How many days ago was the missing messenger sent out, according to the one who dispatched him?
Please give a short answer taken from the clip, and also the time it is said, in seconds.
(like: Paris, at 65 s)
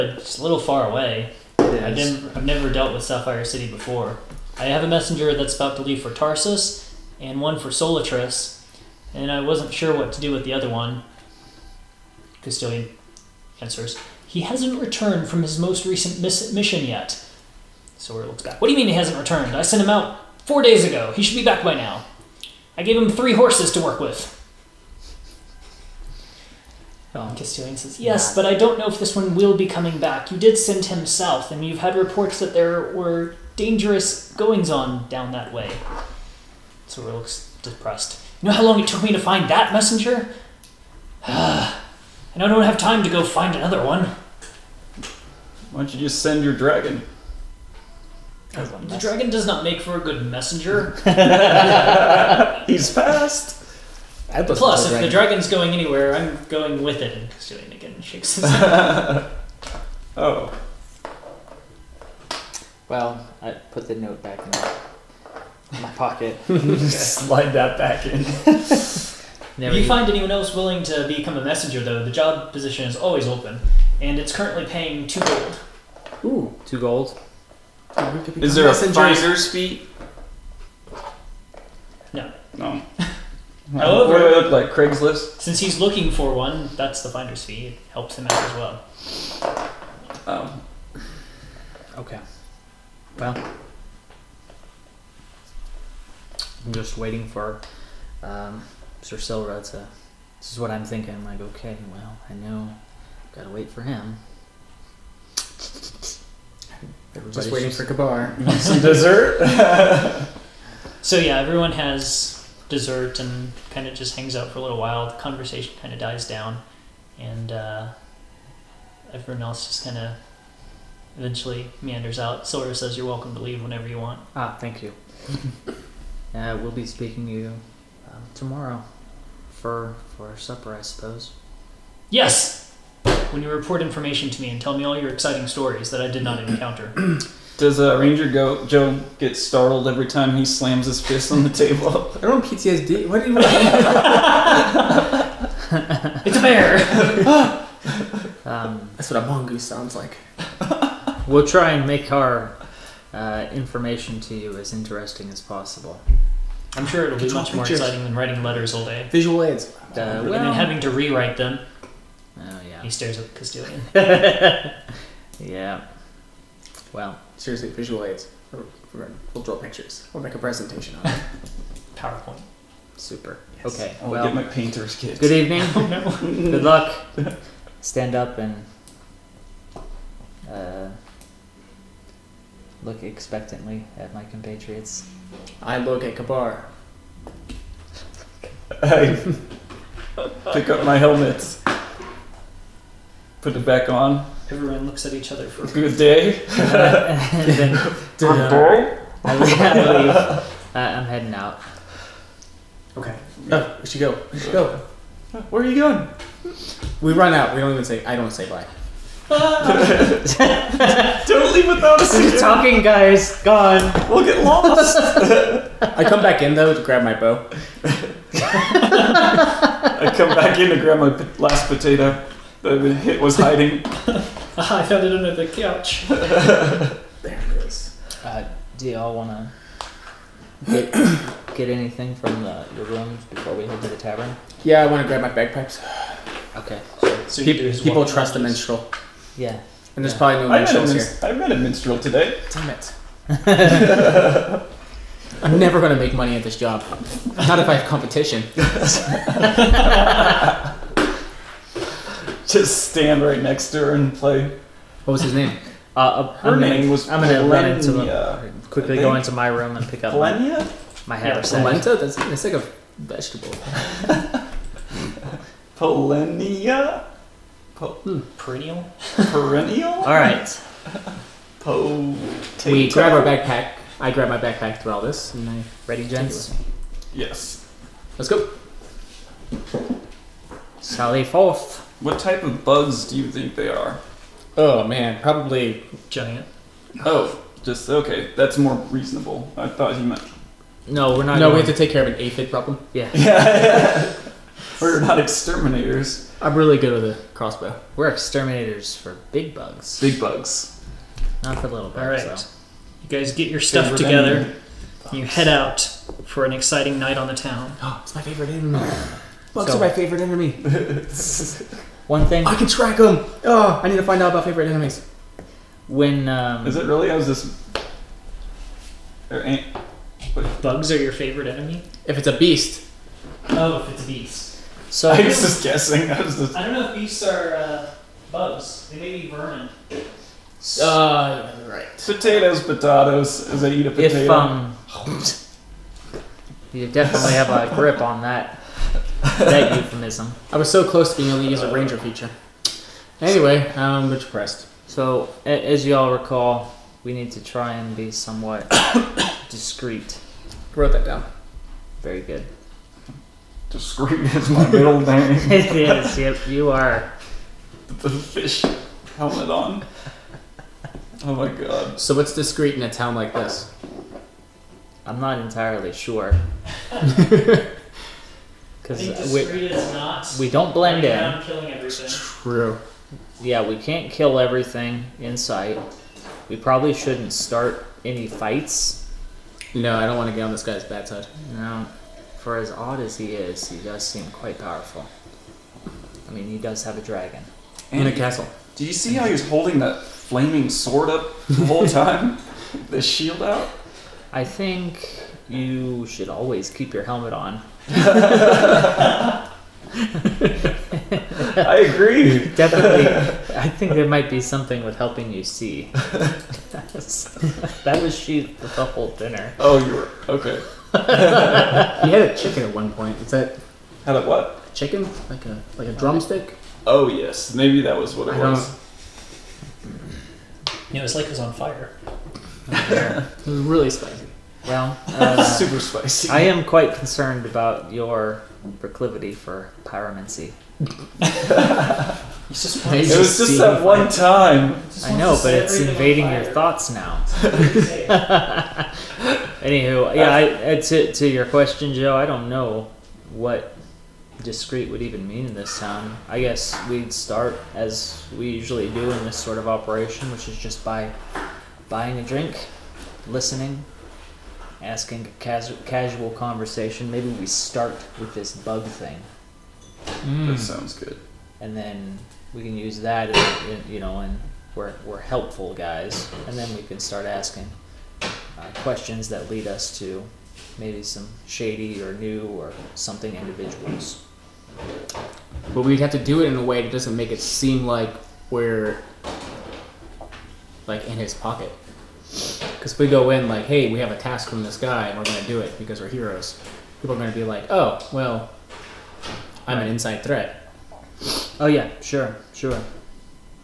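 4, at 20 s.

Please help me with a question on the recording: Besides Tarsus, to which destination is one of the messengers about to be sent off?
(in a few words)
Solitris.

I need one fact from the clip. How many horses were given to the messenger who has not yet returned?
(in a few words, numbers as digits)
3.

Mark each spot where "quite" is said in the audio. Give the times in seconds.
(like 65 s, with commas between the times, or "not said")
384 s, 426 s.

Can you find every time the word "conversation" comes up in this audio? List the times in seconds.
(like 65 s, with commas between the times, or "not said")
115 s, 456 s.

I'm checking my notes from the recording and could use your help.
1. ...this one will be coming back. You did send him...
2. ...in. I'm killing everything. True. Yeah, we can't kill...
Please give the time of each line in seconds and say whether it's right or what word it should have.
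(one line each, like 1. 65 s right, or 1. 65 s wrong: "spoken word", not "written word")
1. 29 s right
2. 371 s right.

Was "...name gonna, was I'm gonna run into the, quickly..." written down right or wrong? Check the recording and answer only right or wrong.
right.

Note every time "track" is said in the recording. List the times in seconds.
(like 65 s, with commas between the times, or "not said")
312 s.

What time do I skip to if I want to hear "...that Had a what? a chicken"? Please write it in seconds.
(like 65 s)
413 s.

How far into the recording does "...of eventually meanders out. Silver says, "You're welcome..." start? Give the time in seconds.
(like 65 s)
119 s.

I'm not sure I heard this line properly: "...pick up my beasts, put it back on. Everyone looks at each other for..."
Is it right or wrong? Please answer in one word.
wrong.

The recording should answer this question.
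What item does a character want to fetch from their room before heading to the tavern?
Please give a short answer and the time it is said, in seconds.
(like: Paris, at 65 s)
bagpipes, at 235 s.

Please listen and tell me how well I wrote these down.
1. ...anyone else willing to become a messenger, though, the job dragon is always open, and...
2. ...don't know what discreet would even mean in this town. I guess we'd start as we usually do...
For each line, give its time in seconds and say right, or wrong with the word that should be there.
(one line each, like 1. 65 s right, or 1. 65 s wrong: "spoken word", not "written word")
1. 70 s wrong: "position", not "dragon"
2. 442 s right.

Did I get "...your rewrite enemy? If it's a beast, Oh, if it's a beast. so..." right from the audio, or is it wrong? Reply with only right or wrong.
wrong.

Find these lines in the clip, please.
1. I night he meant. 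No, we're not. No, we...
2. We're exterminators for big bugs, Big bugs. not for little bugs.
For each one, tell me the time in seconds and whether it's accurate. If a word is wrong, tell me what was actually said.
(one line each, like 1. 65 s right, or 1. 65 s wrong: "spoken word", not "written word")
1. 289 s wrong: "thought", not "night"
2. 297 s right.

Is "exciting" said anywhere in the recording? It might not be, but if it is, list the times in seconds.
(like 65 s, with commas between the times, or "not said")
135 s, 157 s, 306 s.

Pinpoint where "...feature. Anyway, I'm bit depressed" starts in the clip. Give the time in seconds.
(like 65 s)
341 s.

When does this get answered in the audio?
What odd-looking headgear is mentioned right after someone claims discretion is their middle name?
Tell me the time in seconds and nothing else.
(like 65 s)
358 s.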